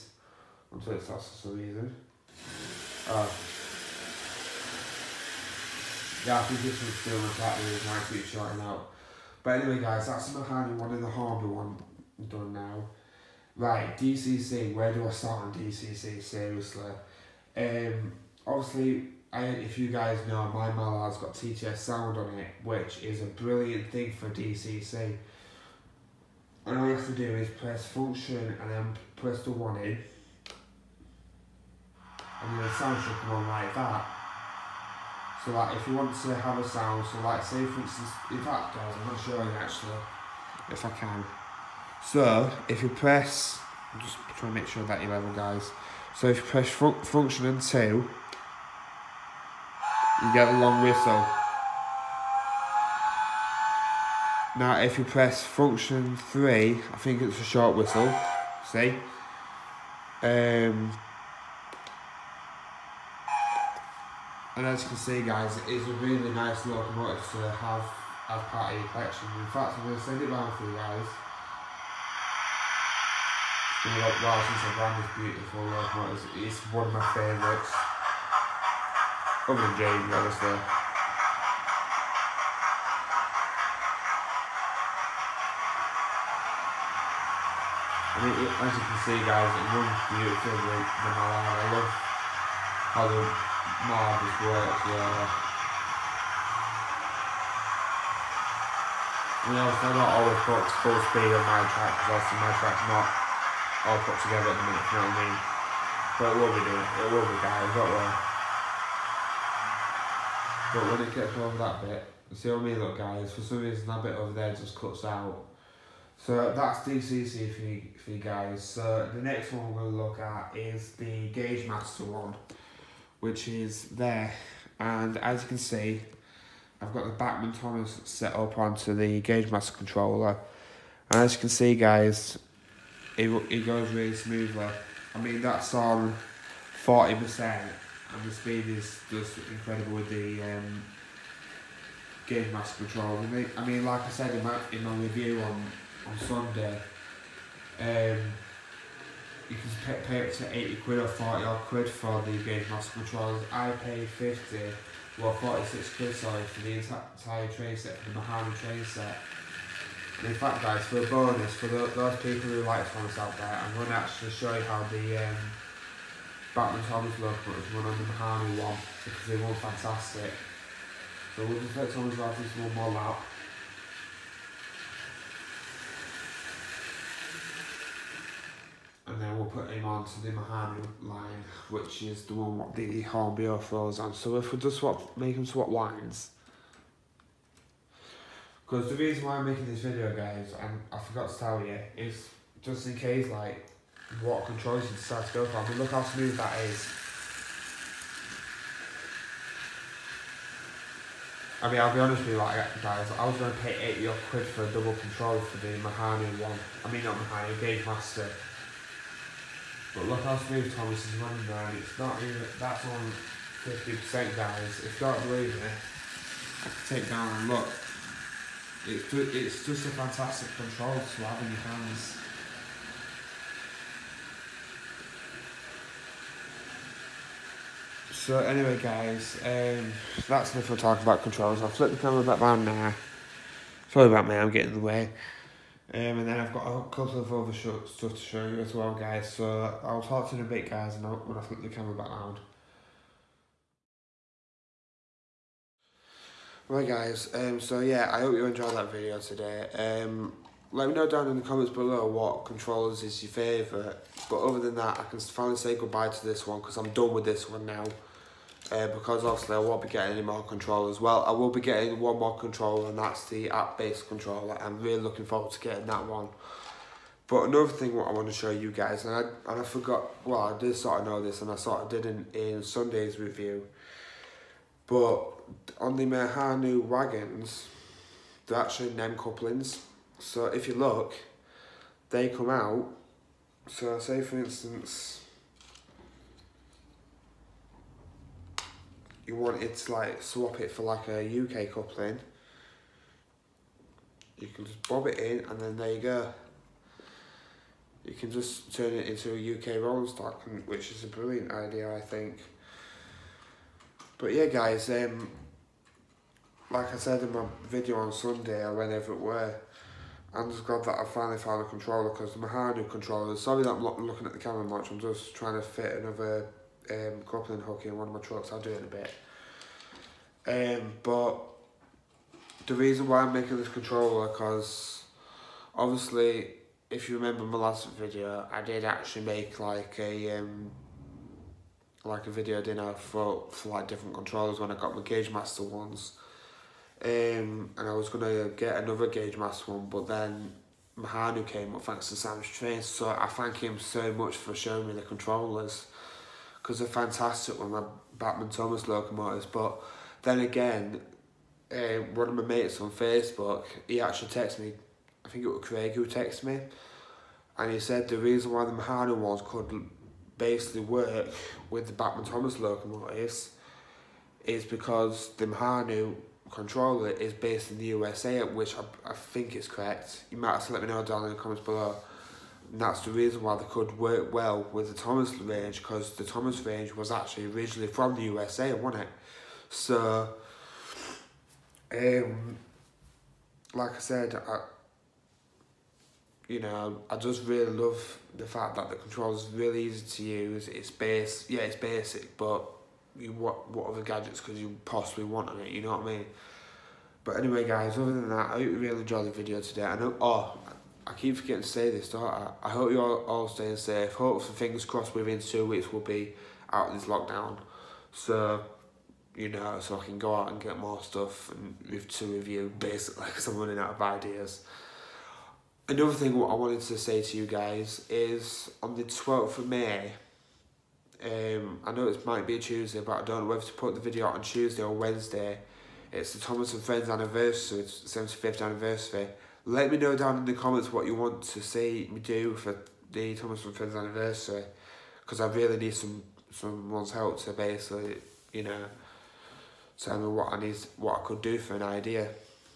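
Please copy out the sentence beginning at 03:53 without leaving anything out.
Sorry about me, I'm getting in the way.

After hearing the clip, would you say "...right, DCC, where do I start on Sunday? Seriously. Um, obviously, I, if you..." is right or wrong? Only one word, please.
wrong.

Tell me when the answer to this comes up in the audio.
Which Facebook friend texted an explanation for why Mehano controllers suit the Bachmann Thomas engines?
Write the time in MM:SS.
05:55.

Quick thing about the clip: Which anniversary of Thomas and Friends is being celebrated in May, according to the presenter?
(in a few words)
75th.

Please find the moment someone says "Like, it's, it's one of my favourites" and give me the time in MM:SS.
01:15.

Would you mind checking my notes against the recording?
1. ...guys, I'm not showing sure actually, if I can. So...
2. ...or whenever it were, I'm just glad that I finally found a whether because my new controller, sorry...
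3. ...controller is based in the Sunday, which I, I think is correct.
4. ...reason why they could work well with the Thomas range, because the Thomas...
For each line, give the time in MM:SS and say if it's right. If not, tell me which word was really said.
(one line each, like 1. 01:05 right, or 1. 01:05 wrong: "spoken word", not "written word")
1. 00:38 right
2. 05:08 wrong: "controller", not "whether"
3. 06:06 wrong: "USA", not "Sunday"
4. 06:13 right.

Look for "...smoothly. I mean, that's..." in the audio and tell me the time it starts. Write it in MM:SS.
02:14.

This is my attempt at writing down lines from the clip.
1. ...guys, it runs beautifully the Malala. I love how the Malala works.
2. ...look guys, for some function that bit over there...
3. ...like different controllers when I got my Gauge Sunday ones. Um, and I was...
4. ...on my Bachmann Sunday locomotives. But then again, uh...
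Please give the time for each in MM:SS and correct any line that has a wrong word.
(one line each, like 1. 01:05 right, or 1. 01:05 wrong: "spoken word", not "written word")
1. 01:29 right
2. 01:52 wrong: "reason", not "function"
3. 05:33 wrong: "Master", not "Sunday"
4. 05:47 wrong: "Thomas", not "Sunday".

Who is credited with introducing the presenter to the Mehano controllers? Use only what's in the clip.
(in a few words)
Sam's Train.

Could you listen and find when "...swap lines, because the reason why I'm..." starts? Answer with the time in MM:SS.
03:05.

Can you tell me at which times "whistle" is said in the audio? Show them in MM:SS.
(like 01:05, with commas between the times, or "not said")
00:50, 00:57.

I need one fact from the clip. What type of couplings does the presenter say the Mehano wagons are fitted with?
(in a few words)
NEM couplings.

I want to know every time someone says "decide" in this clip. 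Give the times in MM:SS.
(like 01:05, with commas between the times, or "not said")
03:14.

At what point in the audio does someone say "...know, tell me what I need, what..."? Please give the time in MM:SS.
07:18.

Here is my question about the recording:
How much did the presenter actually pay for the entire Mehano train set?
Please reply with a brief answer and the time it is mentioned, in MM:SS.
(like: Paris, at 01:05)
46 quid, at 02:35.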